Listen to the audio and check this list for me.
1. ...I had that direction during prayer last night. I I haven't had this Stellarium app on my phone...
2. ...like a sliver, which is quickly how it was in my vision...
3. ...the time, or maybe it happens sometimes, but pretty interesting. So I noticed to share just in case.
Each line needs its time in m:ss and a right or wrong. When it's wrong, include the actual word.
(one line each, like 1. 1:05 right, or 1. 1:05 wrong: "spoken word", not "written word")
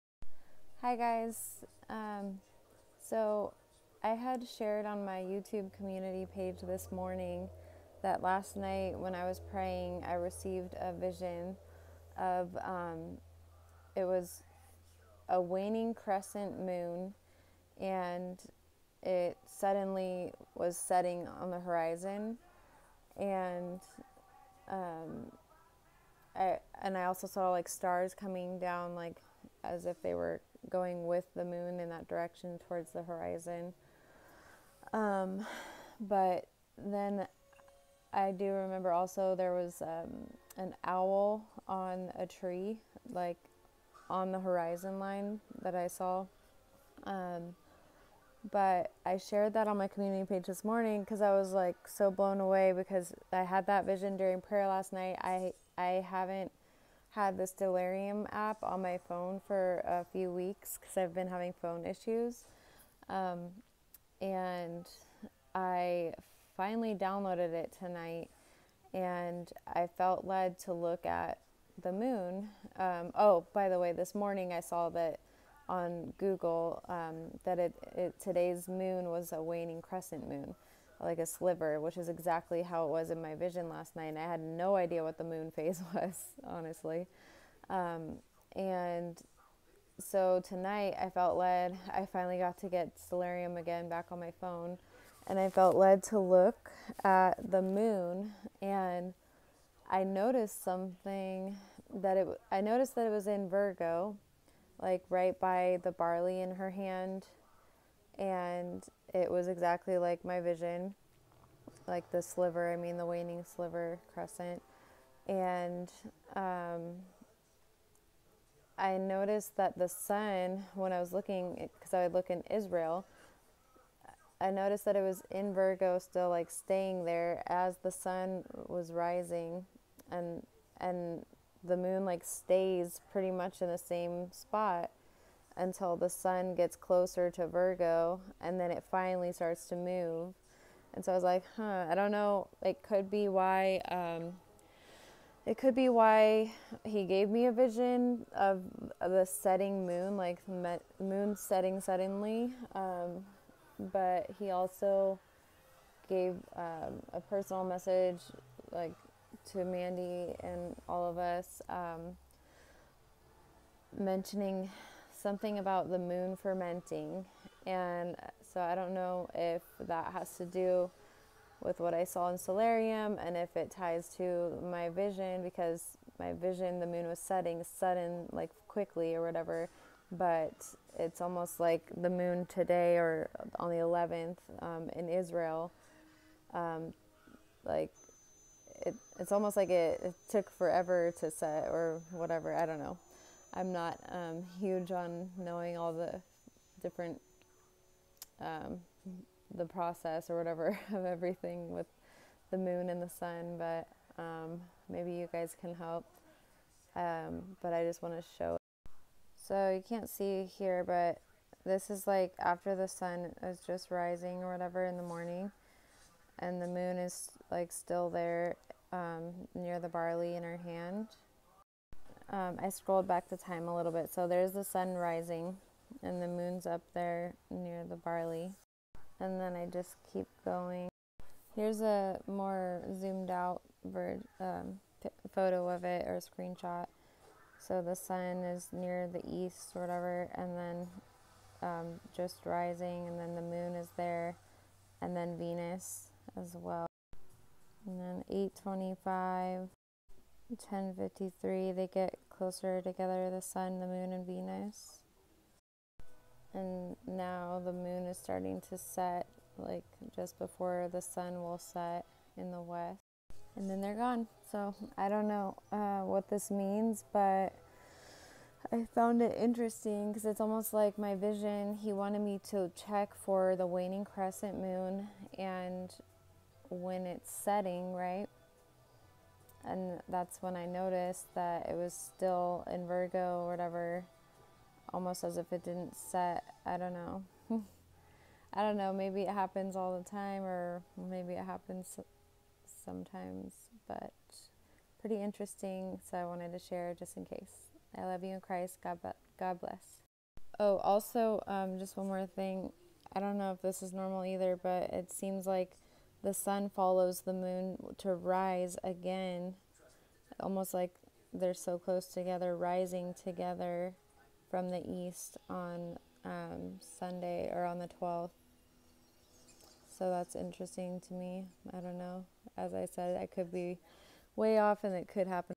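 1. 0:53 wrong: "vision", not "direction"
2. 1:21 wrong: "exactly", not "quickly"
3. 4:49 wrong: "wanted", not "noticed".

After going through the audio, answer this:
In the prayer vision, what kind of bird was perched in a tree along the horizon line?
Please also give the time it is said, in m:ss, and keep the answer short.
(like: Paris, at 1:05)
owl, at 0:40.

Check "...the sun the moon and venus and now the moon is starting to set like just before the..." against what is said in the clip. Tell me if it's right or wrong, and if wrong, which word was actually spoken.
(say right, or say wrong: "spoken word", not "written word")
right.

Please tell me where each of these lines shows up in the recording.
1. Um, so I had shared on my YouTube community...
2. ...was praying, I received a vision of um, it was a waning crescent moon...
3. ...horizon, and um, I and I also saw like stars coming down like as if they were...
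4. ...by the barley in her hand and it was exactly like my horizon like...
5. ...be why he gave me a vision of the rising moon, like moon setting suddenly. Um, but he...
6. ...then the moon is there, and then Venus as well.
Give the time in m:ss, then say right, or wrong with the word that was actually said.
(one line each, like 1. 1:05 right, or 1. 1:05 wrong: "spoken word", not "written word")
1. 0:01 right
2. 0:09 right
3. 0:21 right
4. 1:45 wrong: "vision", not "horizon"
5. 2:25 wrong: "setting", not "rising"
6. 4:03 right.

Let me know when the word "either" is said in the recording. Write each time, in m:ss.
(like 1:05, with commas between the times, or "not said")
5:04.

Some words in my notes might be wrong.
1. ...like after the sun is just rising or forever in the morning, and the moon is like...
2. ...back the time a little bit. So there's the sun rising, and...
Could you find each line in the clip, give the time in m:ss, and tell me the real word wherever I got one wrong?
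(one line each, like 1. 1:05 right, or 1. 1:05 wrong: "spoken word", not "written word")
1. 3:32 wrong: "whatever", not "forever"
2. 3:43 right.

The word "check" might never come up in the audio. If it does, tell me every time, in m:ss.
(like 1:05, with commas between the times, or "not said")
4:32.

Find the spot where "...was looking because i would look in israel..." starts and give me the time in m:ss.
2:00.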